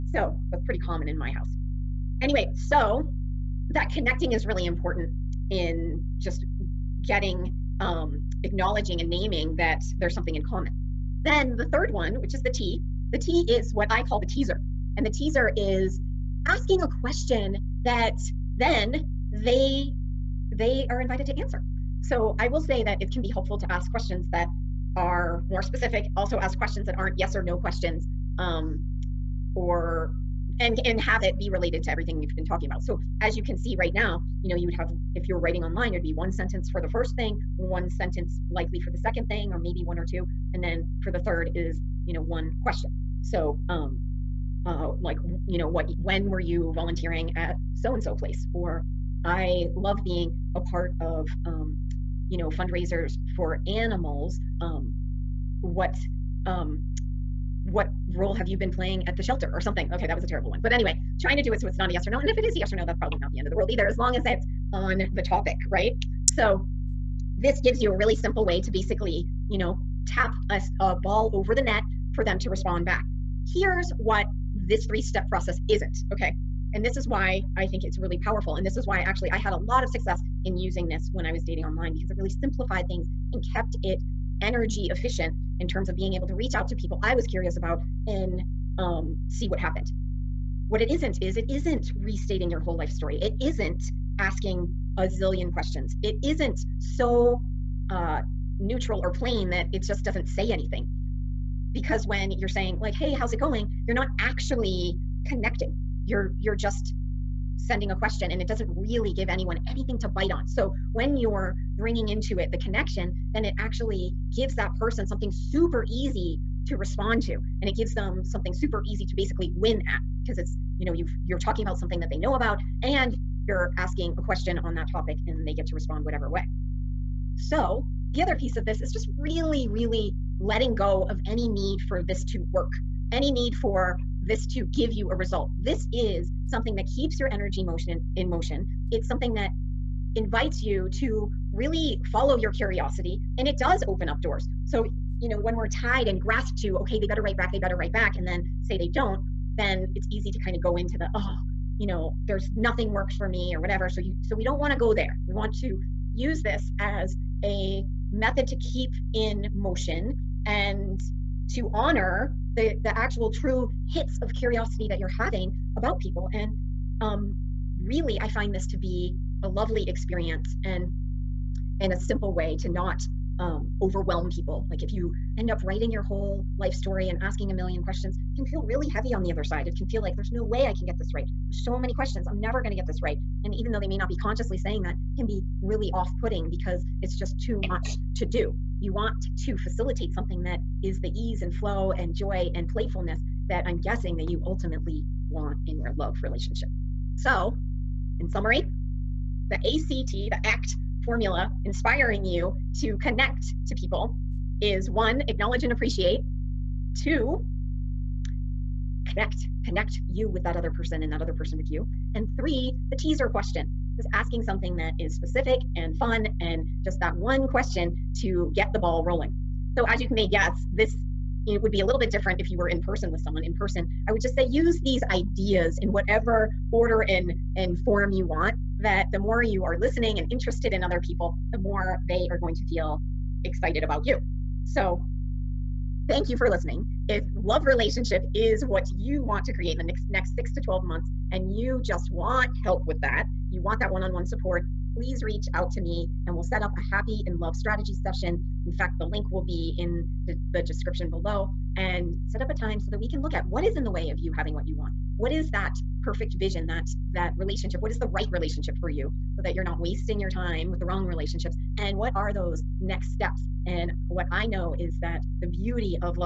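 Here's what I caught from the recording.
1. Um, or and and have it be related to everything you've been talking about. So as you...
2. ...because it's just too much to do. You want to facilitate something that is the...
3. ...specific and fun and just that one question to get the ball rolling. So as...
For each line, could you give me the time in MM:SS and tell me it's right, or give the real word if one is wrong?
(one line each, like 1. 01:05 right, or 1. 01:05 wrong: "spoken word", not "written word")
1. 00:28 right
2. 03:06 right
3. 03:35 right.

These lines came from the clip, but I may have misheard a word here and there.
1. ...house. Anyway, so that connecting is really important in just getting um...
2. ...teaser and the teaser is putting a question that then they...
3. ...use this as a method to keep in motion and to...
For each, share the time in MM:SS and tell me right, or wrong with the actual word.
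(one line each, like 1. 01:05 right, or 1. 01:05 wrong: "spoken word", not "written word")
1. 00:01 right
2. 00:14 wrong: "asking", not "putting"
3. 02:36 right.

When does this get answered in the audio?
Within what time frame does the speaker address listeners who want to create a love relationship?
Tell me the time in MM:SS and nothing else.
04:00.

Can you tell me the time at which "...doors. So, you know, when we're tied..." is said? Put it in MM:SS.
02:24.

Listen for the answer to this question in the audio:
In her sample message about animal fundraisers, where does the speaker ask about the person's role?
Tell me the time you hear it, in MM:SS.
00:59.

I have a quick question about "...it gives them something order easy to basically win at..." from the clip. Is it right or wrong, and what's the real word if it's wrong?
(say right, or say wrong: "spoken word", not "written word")
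wrong: "super", not "order".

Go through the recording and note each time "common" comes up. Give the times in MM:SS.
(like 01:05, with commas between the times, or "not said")
00:00, 00:10.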